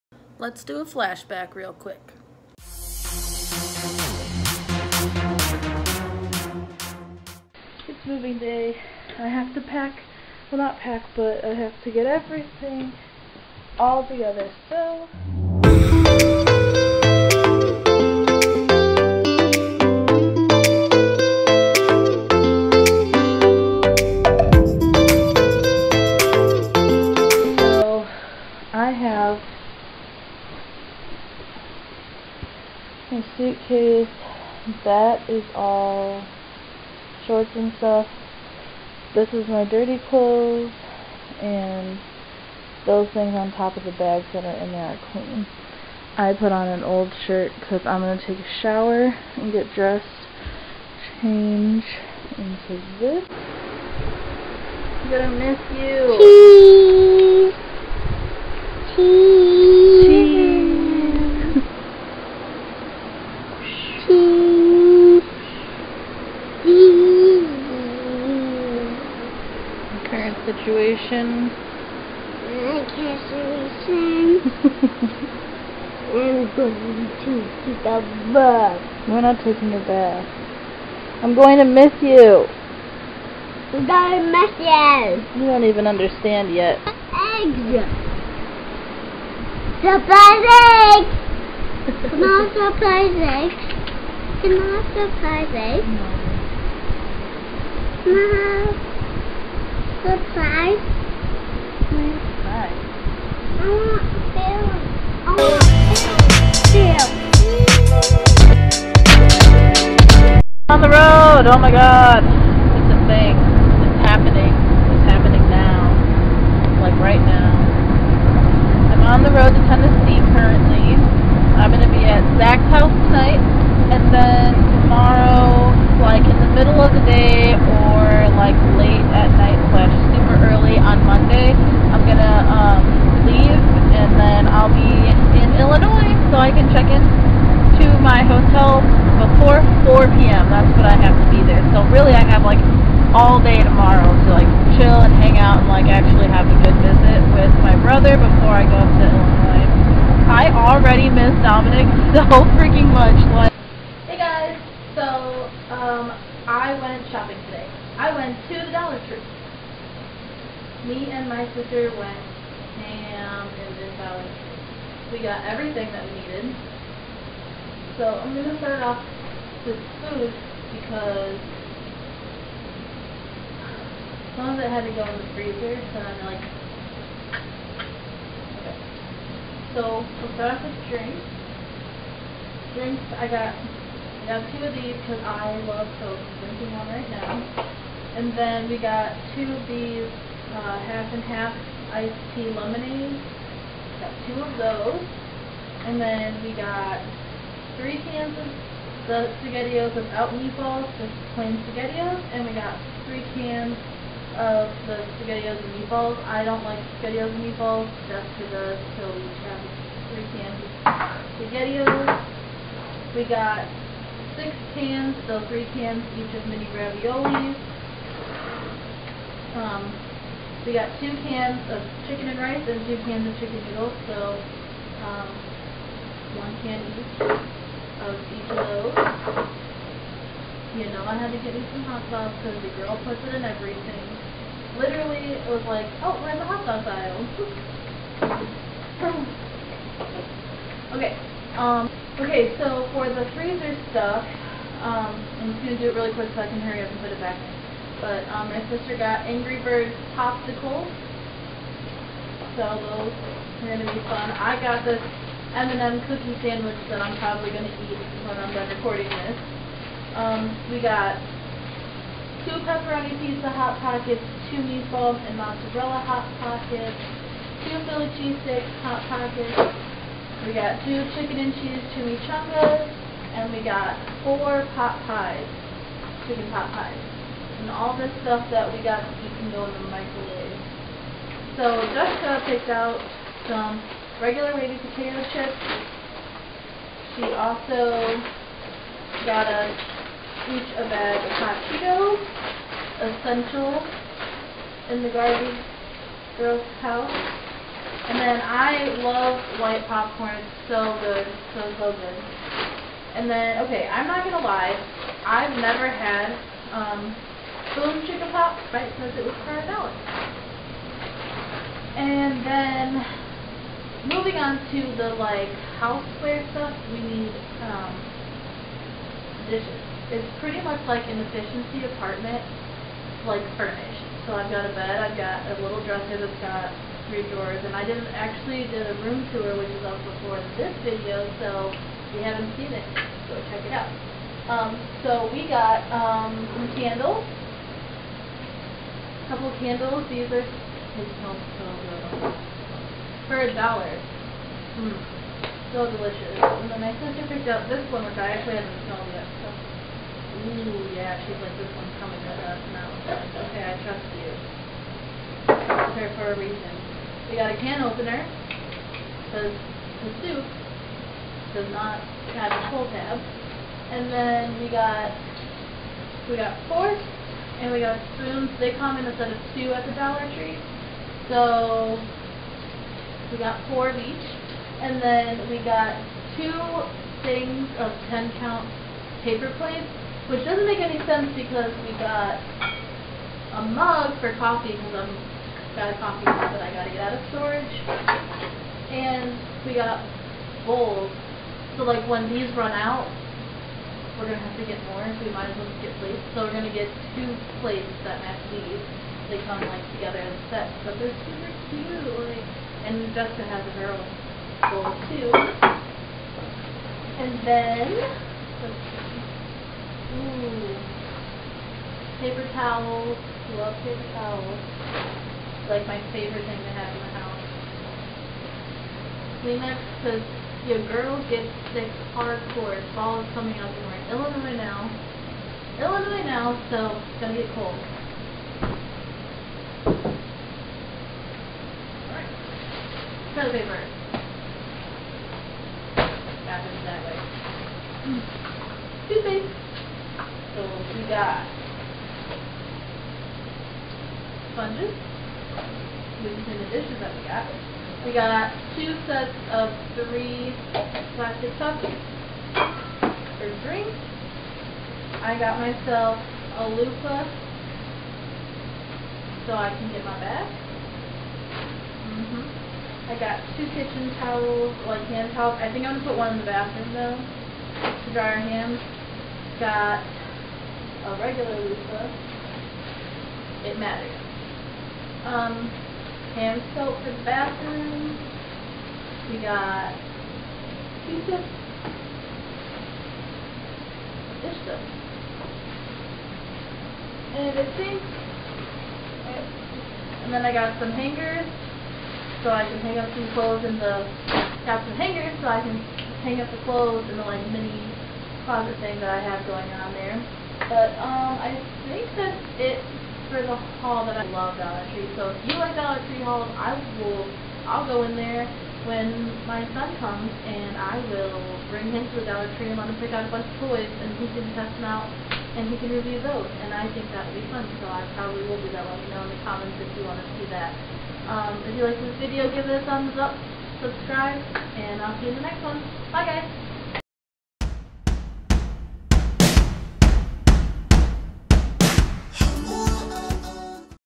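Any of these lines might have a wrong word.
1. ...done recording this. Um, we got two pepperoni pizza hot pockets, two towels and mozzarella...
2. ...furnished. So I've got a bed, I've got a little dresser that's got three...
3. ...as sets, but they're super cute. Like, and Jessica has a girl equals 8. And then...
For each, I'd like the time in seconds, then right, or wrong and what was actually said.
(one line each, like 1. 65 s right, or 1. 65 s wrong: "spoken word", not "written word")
1. 258 s wrong: "meatballs", not "towels"
2. 323 s right
3. 400 s wrong: "2", not "8".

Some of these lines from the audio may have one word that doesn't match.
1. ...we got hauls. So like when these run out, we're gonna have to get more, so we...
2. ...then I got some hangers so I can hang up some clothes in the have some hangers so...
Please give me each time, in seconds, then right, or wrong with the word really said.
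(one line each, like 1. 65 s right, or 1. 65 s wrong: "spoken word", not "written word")
1. 389 s wrong: "bowls", not "hauls"
2. 490 s right.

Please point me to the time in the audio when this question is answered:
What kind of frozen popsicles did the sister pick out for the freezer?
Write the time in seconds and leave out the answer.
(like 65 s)
249 s.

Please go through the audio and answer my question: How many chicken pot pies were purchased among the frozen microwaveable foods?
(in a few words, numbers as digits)
4.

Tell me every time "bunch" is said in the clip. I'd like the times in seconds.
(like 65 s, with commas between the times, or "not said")
513 s.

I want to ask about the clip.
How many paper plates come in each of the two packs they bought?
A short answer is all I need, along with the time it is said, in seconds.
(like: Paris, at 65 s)
10, at 378 s.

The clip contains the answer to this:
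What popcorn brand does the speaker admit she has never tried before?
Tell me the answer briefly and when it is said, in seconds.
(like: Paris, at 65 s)
BoomChickaPop, at 307 s.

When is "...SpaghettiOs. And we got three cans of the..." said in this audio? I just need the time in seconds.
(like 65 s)
201 s.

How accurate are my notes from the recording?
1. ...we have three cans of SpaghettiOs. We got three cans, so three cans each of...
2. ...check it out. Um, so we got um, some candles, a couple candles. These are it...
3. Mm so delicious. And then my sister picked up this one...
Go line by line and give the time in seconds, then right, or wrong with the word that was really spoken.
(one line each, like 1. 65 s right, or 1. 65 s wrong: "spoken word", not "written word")
1. 209 s wrong: "six", not "three"
2. 333 s right
3. 344 s right.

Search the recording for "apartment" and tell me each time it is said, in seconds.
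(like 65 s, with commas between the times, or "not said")
321 s.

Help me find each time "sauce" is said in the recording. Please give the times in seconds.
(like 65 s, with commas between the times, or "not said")
232 s, 236 s.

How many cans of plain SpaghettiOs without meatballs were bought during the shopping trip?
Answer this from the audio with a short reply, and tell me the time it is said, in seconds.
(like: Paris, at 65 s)
3, at 197 s.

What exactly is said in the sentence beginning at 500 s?
But um, I think that's it for the haul that I love Dollar Tree.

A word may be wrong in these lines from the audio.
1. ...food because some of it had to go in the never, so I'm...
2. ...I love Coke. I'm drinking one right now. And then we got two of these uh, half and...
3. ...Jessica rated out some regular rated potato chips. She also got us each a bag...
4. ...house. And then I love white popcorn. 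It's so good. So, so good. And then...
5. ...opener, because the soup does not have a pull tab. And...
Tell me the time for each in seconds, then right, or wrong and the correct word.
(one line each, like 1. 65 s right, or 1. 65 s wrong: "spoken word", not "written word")
1. 169 s wrong: "freezer", not "never"
2. 185 s right
3. 281 s wrong: "picked", not "rated"
4. 296 s right
5. 357 s right.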